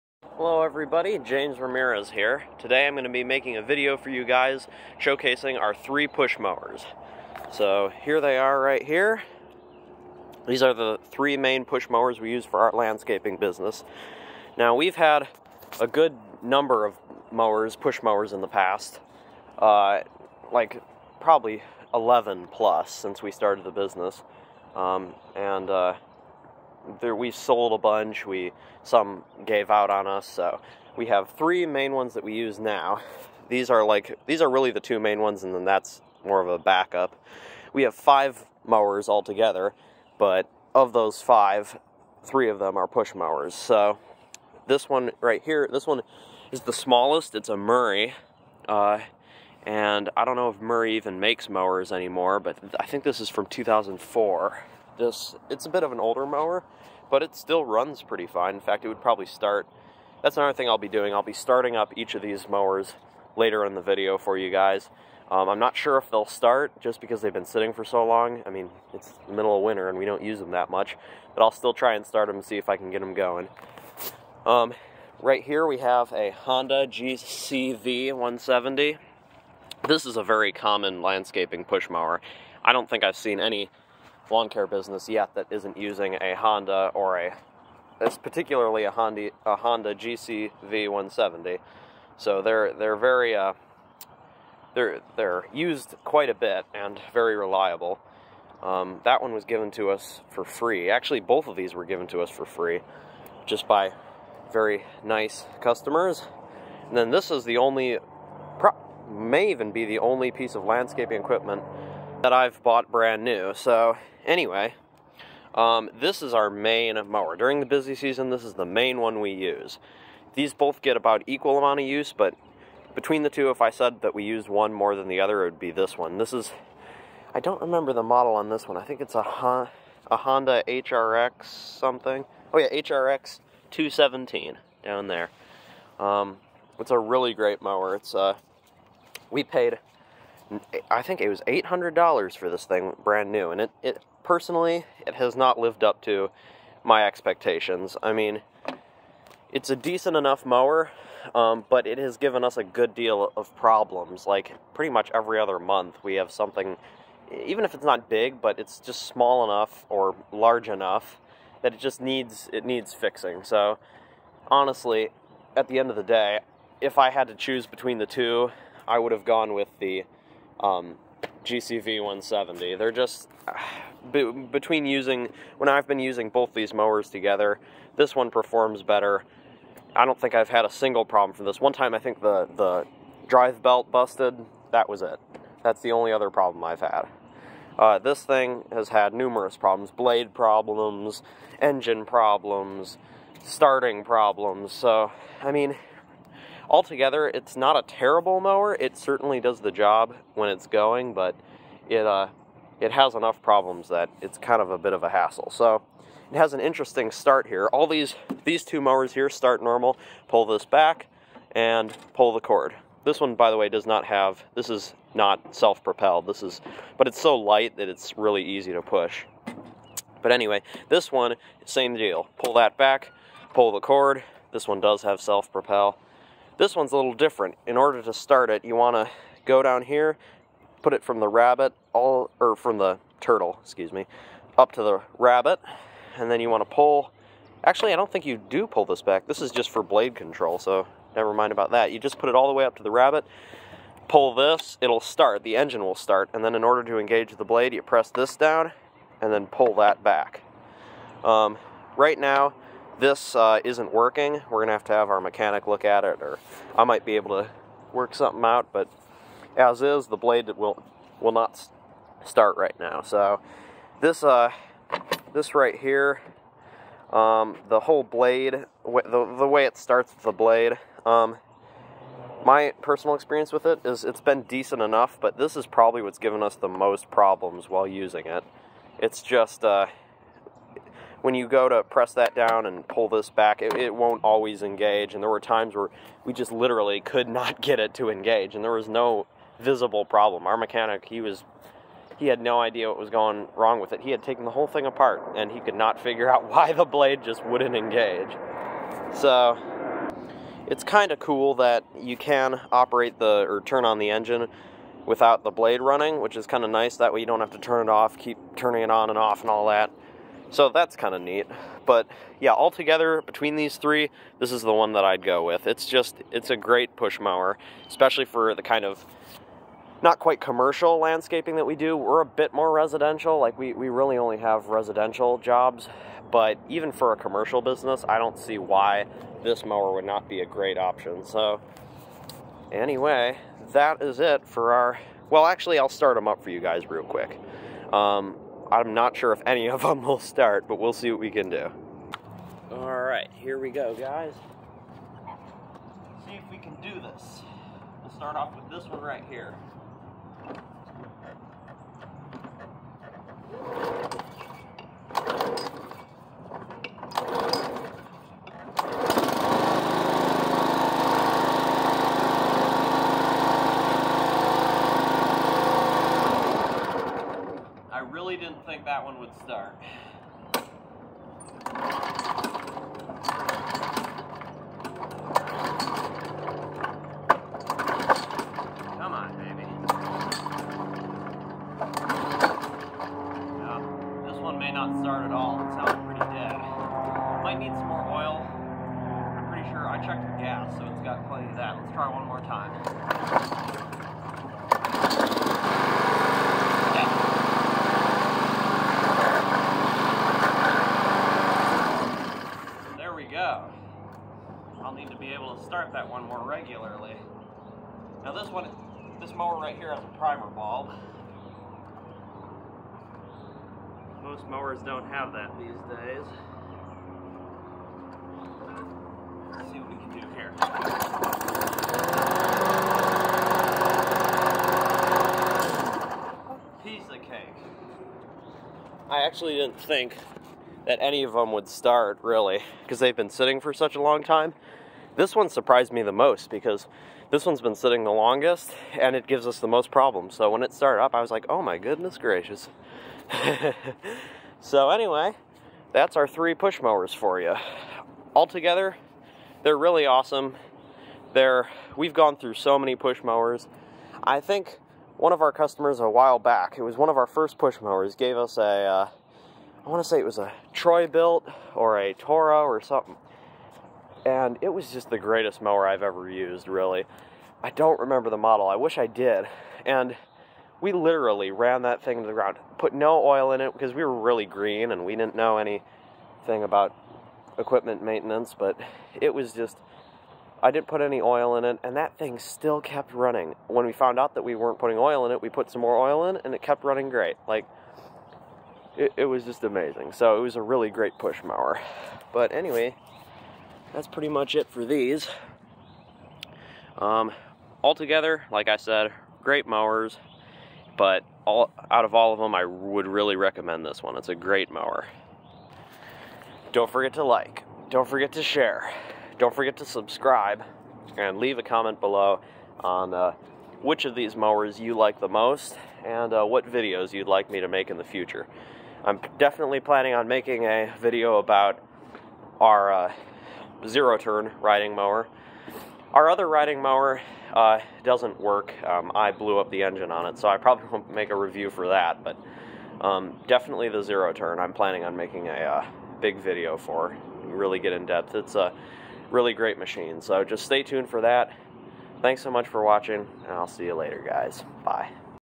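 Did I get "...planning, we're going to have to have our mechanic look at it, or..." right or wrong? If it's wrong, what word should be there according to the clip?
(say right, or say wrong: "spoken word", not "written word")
wrong: "working", not "planning".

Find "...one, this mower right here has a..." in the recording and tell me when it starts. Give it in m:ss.
6:48.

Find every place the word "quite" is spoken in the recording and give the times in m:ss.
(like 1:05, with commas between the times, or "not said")
1:36, 5:20.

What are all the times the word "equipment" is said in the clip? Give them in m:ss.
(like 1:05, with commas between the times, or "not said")
1:51, 7:57.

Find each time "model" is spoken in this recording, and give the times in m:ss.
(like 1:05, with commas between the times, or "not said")
2:08, 7:48.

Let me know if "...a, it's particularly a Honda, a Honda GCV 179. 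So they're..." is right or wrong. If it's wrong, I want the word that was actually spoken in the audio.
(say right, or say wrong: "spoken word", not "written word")
wrong: "170", not "179".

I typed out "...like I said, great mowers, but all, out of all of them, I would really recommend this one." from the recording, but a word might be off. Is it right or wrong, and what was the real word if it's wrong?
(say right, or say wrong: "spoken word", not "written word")
right.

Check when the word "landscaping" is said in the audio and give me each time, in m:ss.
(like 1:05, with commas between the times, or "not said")
0:12, 1:21, 1:50, 5:20.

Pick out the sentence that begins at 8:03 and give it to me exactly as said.
When we found out that we weren't putting oil in it, we put some more oil in, and it kept running great.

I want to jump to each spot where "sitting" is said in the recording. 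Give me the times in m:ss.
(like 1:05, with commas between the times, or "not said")
1:07, 7:13, 7:17.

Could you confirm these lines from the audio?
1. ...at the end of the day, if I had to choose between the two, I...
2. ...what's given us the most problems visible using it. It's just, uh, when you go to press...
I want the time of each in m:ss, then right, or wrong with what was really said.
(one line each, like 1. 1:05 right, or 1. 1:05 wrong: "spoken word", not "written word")
1. 2:45 right
2. 4:36 wrong: "while", not "visible".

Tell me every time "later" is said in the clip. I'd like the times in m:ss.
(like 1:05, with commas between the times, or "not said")
1:03, 9:03.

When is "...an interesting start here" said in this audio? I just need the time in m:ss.
3:26.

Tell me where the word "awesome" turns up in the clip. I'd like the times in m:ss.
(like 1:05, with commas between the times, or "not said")
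7:30.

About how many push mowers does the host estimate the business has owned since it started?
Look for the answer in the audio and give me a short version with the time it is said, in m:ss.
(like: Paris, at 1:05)
11, at 0:21.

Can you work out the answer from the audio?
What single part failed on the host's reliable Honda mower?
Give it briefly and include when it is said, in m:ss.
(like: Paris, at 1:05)
drive belt, at 3:03.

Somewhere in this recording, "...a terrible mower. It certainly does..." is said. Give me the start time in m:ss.
3:17.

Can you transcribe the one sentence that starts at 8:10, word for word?
So it was a really great push mower.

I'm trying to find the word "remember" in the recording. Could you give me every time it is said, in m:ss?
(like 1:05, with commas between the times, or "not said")
2:07, 7:47.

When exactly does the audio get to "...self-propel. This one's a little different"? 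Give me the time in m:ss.
3:45.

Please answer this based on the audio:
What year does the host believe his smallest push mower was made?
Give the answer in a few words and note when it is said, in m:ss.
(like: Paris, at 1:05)
2004, at 0:53.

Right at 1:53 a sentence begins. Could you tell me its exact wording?
So Anyway, um, this is our main mower.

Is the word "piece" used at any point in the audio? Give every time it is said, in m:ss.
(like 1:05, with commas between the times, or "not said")
1:50, 7:06.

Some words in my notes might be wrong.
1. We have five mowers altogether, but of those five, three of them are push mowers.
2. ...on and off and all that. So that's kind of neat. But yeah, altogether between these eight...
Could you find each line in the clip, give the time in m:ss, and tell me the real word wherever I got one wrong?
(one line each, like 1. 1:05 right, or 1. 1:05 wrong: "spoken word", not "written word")
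1. 0:37 right
2. 5:08 wrong: "three", not "eight".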